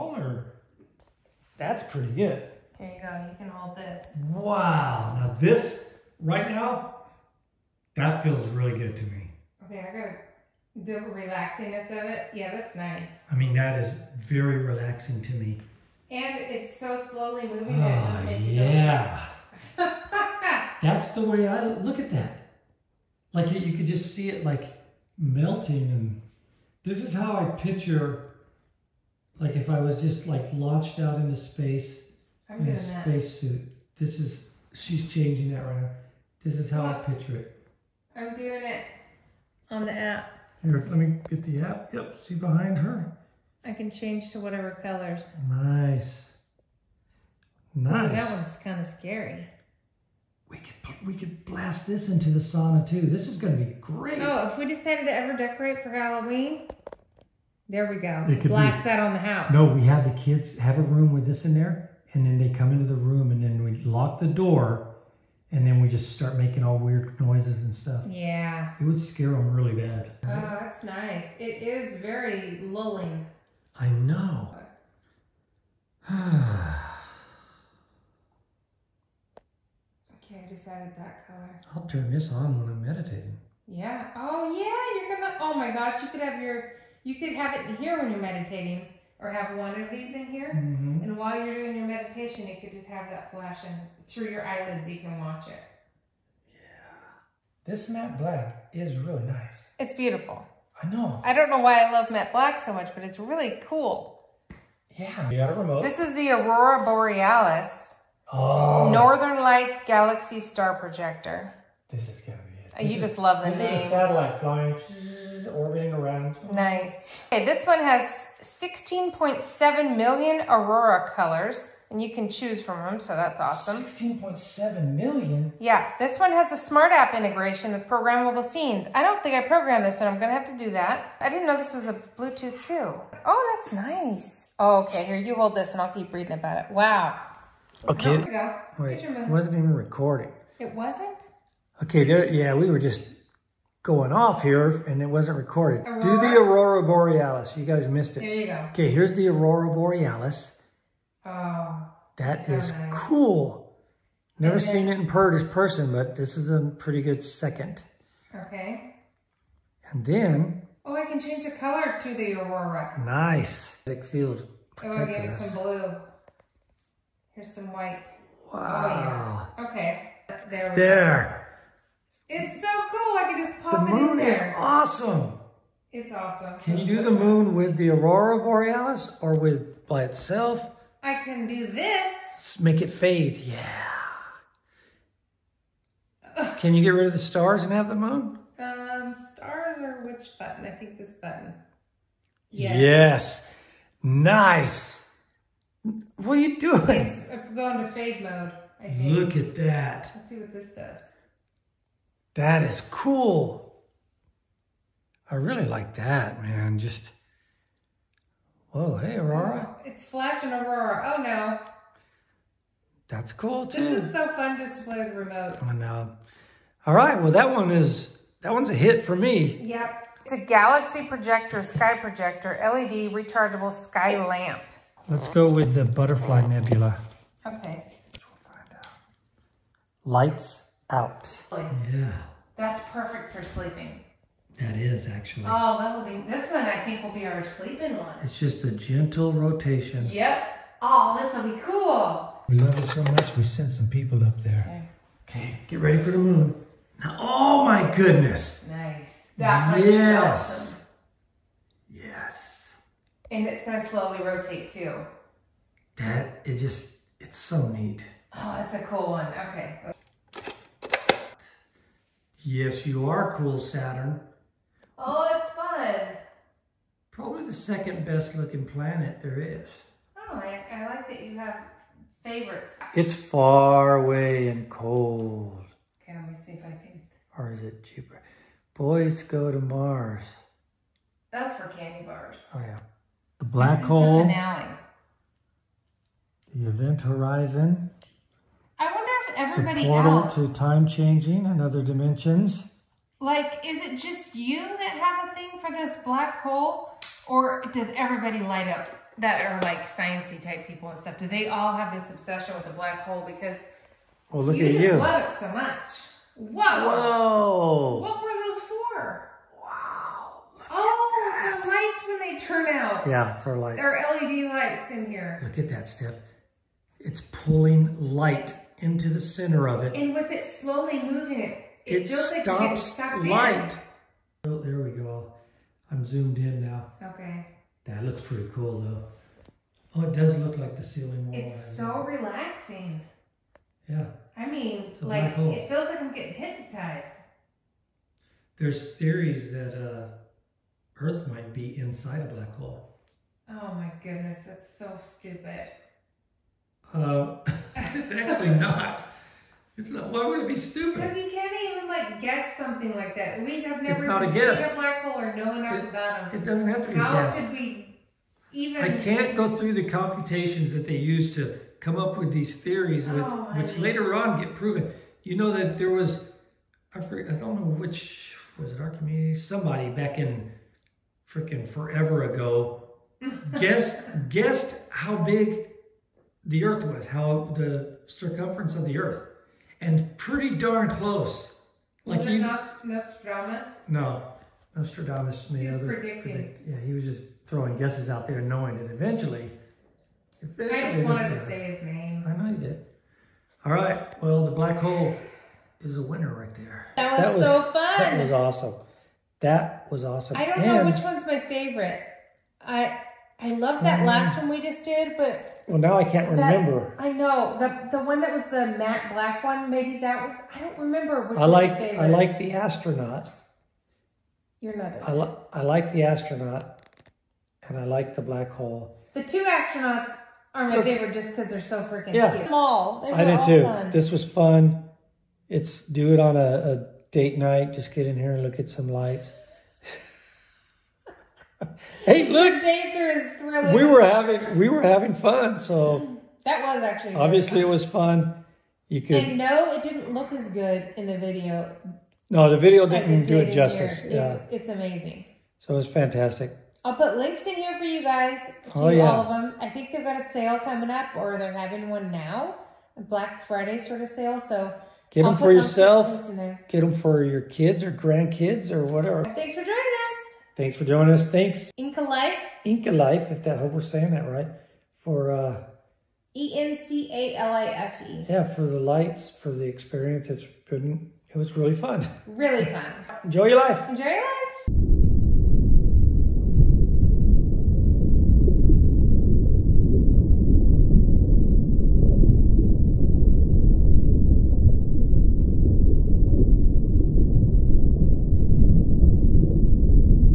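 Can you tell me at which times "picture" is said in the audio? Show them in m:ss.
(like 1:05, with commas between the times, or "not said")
0:27, 0:36.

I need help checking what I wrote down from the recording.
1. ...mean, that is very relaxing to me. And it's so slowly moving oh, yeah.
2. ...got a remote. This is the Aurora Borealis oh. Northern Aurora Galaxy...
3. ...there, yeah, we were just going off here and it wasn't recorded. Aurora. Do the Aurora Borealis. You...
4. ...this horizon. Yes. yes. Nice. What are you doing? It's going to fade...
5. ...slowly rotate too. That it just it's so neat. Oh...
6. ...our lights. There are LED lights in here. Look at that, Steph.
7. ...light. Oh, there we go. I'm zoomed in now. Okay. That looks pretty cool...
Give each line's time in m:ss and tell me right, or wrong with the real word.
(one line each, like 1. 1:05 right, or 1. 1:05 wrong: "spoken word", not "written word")
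1. 0:13 right
2. 1:45 wrong: "Lights", not "Aurora"
3. 2:22 right
4. 3:10 wrong: "button", not "horizon"
5. 4:13 right
6. 5:13 right
7. 5:23 right.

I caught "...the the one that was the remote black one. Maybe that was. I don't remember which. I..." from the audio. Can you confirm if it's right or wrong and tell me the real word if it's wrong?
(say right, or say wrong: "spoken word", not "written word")
wrong: "matte", not "remote".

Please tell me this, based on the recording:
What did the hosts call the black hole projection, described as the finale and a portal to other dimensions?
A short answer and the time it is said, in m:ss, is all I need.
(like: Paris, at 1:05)
The event horizon, at 4:46.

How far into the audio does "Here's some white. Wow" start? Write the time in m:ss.
2:47.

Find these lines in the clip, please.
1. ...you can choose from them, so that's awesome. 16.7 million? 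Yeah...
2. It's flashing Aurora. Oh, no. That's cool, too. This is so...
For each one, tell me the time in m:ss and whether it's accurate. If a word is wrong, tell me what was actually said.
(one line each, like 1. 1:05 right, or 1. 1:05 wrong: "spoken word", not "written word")
1. 2:02 right
2. 3:29 right.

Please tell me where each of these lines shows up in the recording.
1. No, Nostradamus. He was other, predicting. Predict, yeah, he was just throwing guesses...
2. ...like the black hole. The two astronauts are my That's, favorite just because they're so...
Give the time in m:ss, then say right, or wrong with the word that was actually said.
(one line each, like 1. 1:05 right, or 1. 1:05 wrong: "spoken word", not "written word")
1. 6:23 right
2. 6:57 right.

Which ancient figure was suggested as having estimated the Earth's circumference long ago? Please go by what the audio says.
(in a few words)
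Archimedes.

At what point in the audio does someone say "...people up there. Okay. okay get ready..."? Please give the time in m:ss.
4:03.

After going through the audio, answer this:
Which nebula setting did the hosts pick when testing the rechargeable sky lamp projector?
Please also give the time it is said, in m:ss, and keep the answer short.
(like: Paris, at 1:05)
Butterfly Nebula, at 3:45.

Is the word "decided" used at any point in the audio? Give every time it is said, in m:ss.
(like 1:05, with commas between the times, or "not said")
0:54, 1:20.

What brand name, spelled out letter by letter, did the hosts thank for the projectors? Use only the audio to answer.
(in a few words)
Encalife.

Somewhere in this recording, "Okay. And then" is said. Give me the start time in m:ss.
2:38.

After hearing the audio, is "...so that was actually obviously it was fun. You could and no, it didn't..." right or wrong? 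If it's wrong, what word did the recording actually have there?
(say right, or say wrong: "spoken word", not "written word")
right.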